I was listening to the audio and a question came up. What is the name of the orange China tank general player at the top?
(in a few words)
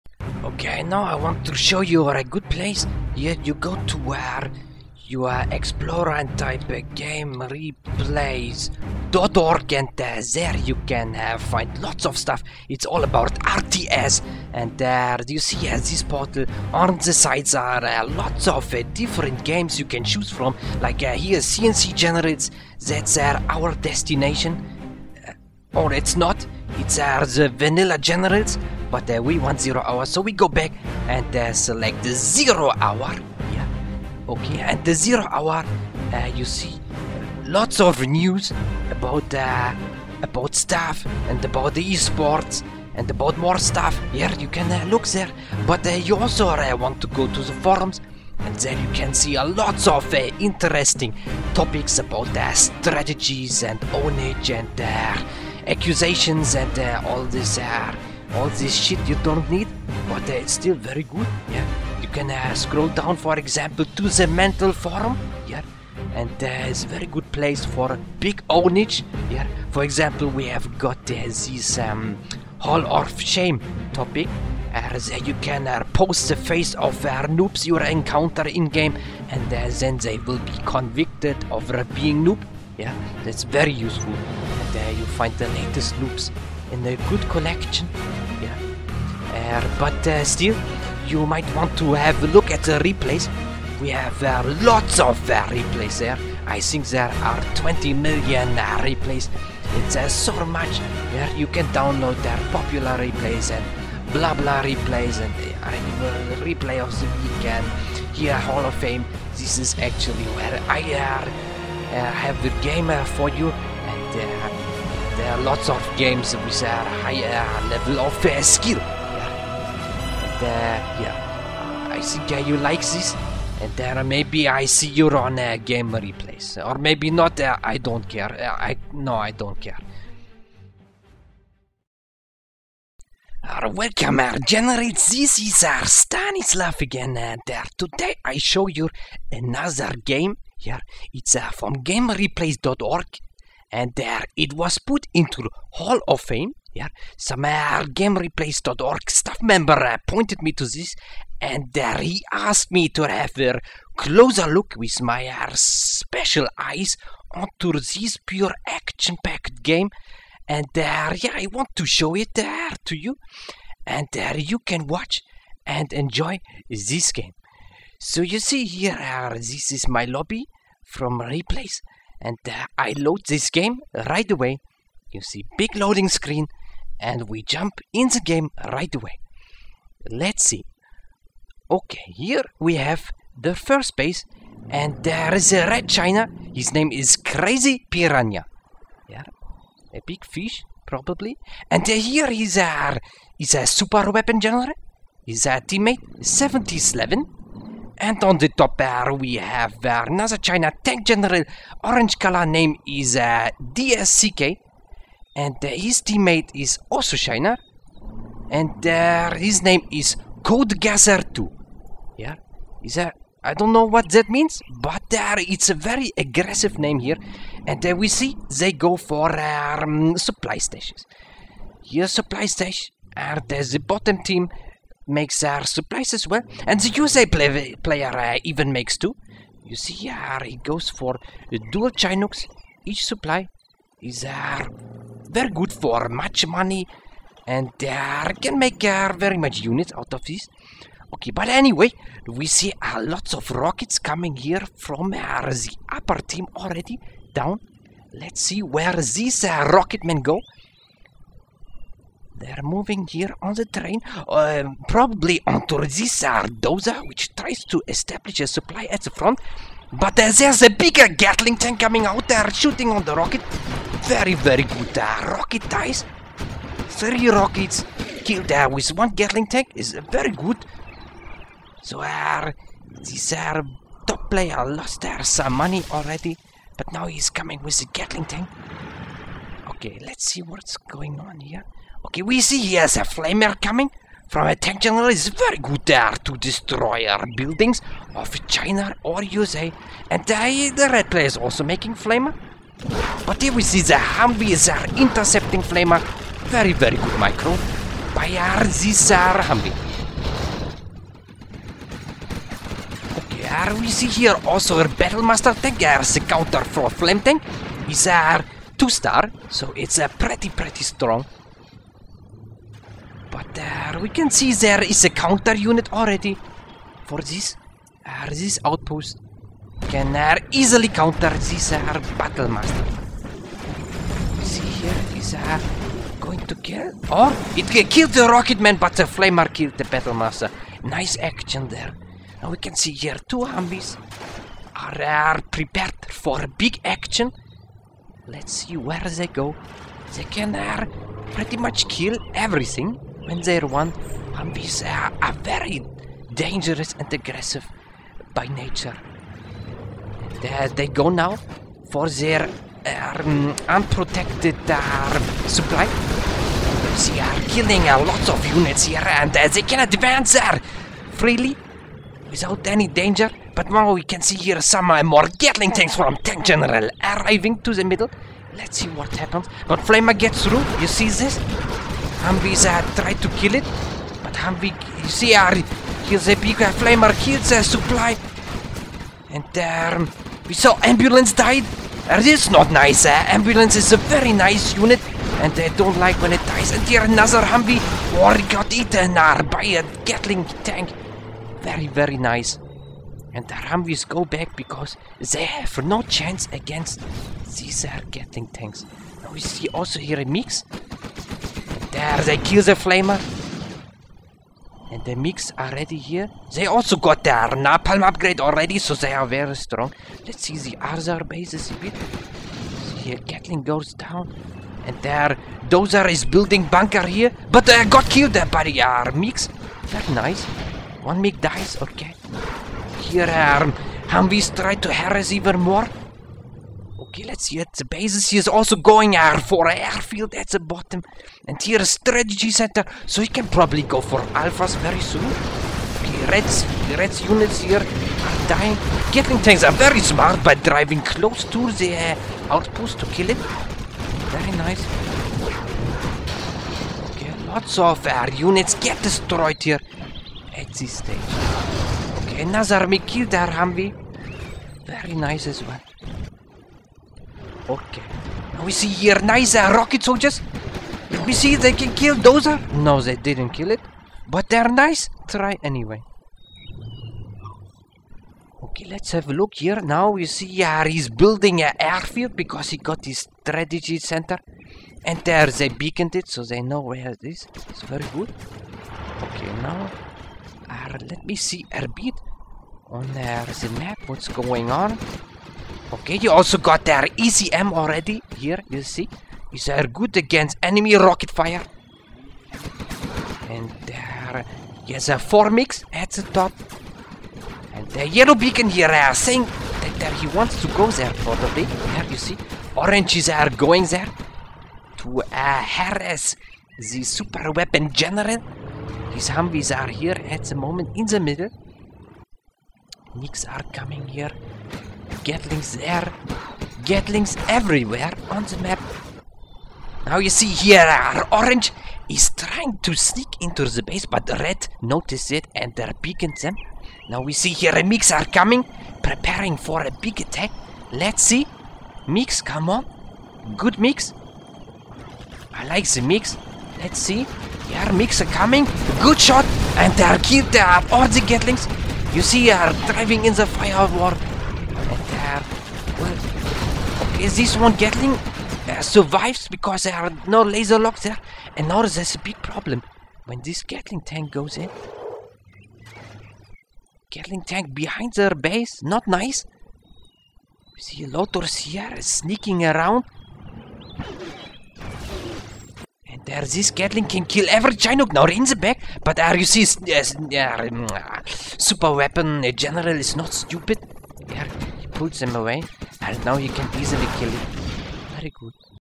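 DSCK.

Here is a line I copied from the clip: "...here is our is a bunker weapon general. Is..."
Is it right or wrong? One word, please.
wrong.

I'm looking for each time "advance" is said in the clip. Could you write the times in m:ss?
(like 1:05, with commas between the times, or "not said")
5:59.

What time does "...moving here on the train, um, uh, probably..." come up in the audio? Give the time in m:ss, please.
4:12.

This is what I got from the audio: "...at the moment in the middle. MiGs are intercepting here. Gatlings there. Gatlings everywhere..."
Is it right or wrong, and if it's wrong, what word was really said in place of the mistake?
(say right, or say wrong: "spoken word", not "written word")
wrong: "coming", not "intercepting".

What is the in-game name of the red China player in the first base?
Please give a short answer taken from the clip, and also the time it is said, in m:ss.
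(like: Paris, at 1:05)
Crazy Piranha, at 3:07.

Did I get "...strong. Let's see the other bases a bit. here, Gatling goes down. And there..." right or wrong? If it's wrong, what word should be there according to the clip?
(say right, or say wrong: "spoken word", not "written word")
right.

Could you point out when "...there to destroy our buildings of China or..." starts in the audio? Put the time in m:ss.
4:45.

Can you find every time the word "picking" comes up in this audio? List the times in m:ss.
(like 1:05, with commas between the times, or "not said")
8:46.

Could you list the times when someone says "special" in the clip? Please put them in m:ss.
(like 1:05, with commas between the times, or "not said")
2:35.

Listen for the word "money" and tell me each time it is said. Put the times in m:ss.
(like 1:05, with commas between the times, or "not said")
3:56, 4:35.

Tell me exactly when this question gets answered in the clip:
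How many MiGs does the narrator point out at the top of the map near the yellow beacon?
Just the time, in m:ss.
8:15.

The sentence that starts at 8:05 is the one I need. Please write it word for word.
Okay, you also got their ECM already.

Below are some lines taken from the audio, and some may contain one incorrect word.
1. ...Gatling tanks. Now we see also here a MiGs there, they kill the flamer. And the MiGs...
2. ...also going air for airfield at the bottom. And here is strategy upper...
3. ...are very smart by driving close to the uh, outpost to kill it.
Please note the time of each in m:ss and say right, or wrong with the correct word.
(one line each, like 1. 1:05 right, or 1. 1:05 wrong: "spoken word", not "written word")
1. 6:38 right
2. 7:08 wrong: "center", not "upper"
3. 7:19 right.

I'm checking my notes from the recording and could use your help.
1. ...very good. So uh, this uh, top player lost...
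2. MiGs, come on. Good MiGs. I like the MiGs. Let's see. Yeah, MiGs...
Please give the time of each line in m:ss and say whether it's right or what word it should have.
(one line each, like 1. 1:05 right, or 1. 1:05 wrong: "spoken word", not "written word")
1. 4:30 right
2. 8:52 right.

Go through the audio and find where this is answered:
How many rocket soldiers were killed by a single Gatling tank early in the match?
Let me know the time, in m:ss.
4:26.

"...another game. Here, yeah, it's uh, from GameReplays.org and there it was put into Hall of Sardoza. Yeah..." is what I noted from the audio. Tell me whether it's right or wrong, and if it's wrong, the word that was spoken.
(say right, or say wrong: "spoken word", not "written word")
wrong: "Fame", not "Sardoza".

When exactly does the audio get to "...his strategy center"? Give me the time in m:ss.
7:53.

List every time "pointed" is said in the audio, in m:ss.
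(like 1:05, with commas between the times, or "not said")
2:30.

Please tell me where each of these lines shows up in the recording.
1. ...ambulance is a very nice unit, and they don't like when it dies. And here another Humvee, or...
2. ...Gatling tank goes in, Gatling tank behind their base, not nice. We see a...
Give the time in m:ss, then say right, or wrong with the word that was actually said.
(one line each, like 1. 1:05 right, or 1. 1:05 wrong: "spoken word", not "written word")
1. 6:23 right
2. 9:13 right.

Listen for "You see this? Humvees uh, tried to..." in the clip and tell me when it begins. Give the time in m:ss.
6:10.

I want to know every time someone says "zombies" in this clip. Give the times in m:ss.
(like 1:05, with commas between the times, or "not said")
5:33.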